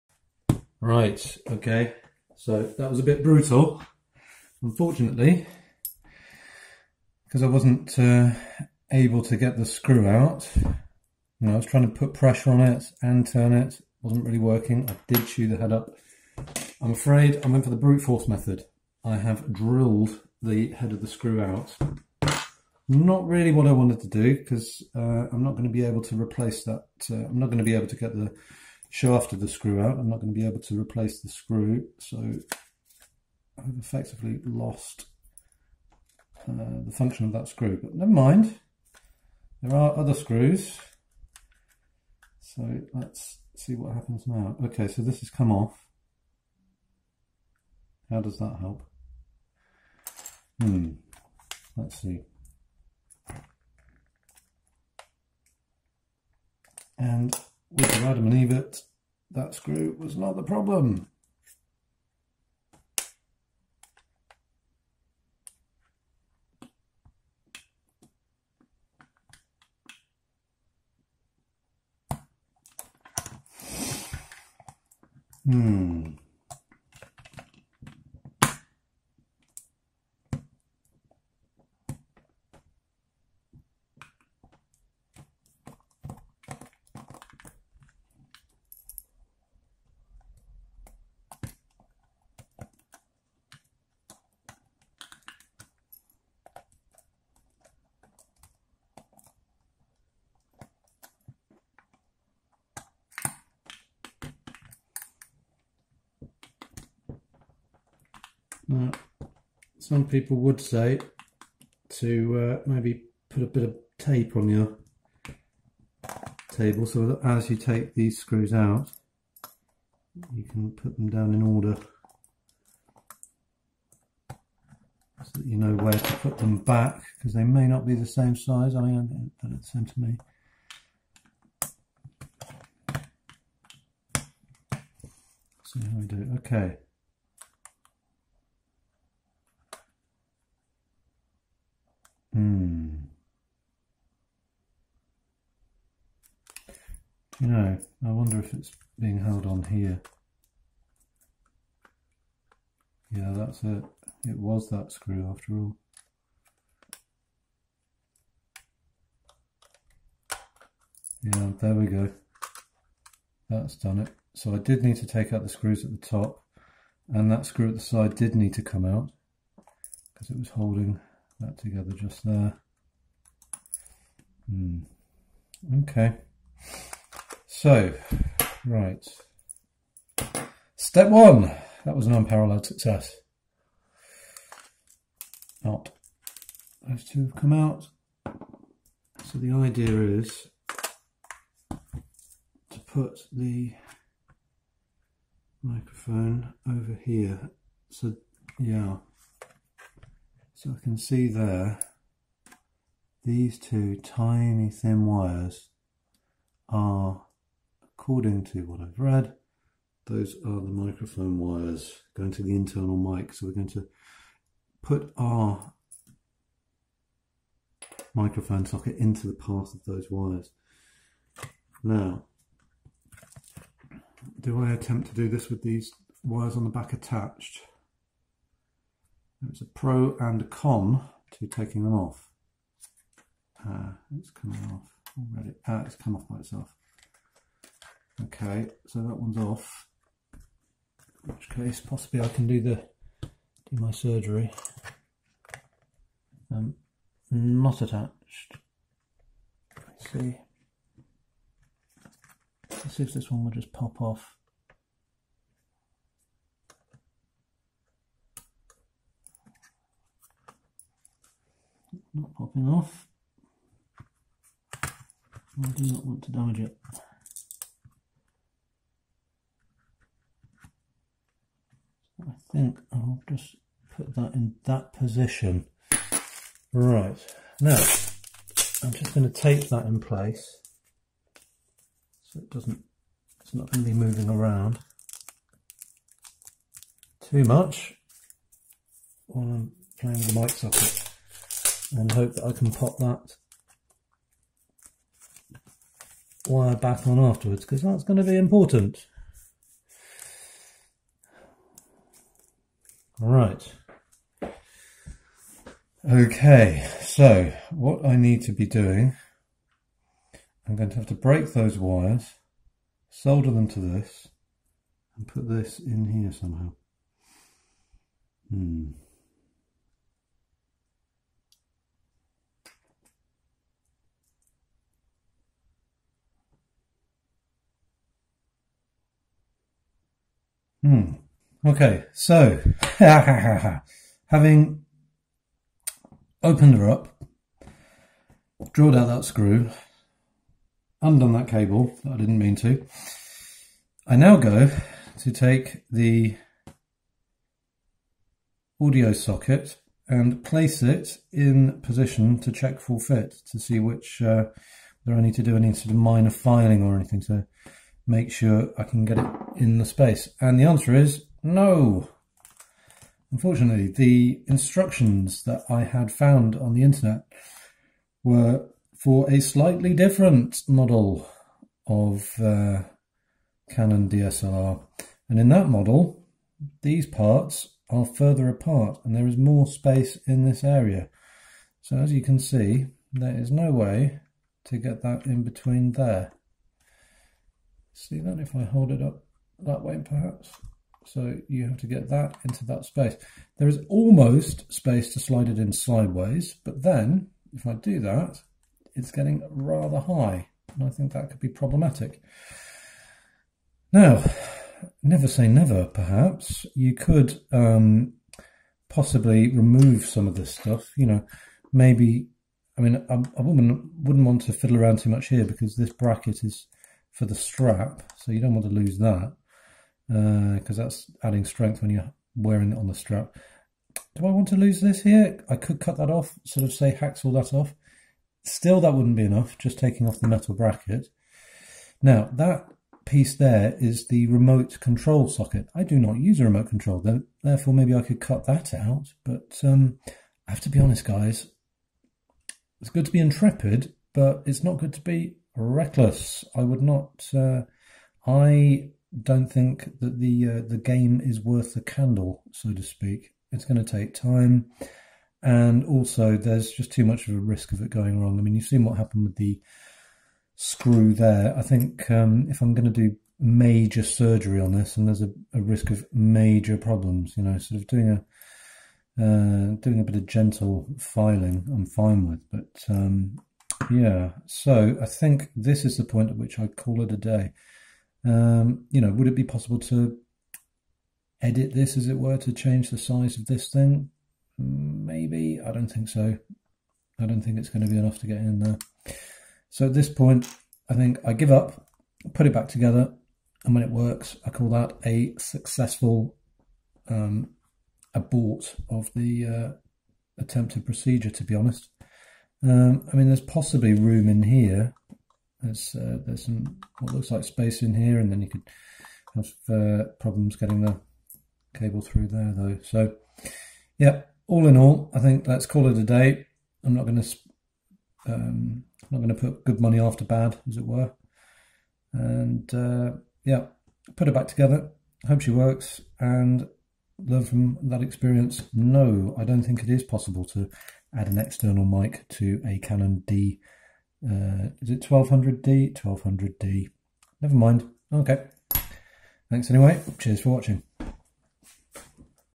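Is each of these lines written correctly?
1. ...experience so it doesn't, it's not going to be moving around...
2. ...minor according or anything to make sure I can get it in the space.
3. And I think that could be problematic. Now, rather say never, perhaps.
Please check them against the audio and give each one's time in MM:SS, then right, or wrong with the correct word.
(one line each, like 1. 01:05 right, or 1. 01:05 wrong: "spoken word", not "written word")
1. 04:39 wrong: "place", not "experience"
2. 05:55 wrong: "filing", not "according"
3. 06:40 wrong: "never", not "rather".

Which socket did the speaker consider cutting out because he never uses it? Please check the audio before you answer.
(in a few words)
Remote control socket.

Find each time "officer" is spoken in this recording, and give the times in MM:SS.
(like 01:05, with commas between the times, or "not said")
not said.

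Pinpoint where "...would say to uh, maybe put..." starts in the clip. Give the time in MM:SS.
01:50.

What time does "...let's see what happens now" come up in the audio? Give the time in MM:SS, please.
00:42.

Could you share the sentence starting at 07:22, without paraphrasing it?
It's good to be intrepid, but it's not good to be reckless.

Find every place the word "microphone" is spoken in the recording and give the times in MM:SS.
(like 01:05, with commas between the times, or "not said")
03:15, 03:30, 03:38.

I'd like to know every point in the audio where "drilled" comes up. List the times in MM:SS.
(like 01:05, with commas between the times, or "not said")
00:19, 05:38.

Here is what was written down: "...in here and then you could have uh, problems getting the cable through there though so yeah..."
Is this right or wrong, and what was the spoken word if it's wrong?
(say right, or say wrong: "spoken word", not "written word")
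right.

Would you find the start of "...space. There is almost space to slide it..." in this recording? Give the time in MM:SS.
06:32.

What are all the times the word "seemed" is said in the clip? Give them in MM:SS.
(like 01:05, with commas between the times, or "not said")
02:09.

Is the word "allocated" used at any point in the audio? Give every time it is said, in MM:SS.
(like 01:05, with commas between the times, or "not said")
not said.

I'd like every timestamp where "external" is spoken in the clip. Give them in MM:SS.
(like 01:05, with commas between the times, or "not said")
08:51.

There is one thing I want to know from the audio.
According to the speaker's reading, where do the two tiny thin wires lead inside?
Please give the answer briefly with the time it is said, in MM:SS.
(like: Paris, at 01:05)
Internal mic, at 03:32.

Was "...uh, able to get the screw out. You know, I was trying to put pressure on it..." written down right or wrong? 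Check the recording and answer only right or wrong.
right.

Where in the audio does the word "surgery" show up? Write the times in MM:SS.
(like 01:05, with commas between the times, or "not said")
04:03, 07:44.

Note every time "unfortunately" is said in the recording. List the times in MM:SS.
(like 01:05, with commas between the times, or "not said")
00:04, 06:03.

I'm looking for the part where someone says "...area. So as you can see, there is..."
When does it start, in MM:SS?
06:20.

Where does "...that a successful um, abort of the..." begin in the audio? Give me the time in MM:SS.
08:14.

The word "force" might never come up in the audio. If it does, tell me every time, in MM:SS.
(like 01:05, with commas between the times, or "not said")
00:18.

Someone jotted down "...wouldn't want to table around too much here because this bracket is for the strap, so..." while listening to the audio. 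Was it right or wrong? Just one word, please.
wrong.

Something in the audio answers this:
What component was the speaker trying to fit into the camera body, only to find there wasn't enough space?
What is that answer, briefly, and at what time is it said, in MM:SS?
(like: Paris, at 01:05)
Audio socket, at 05:48.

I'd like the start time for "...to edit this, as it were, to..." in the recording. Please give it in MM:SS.
07:59.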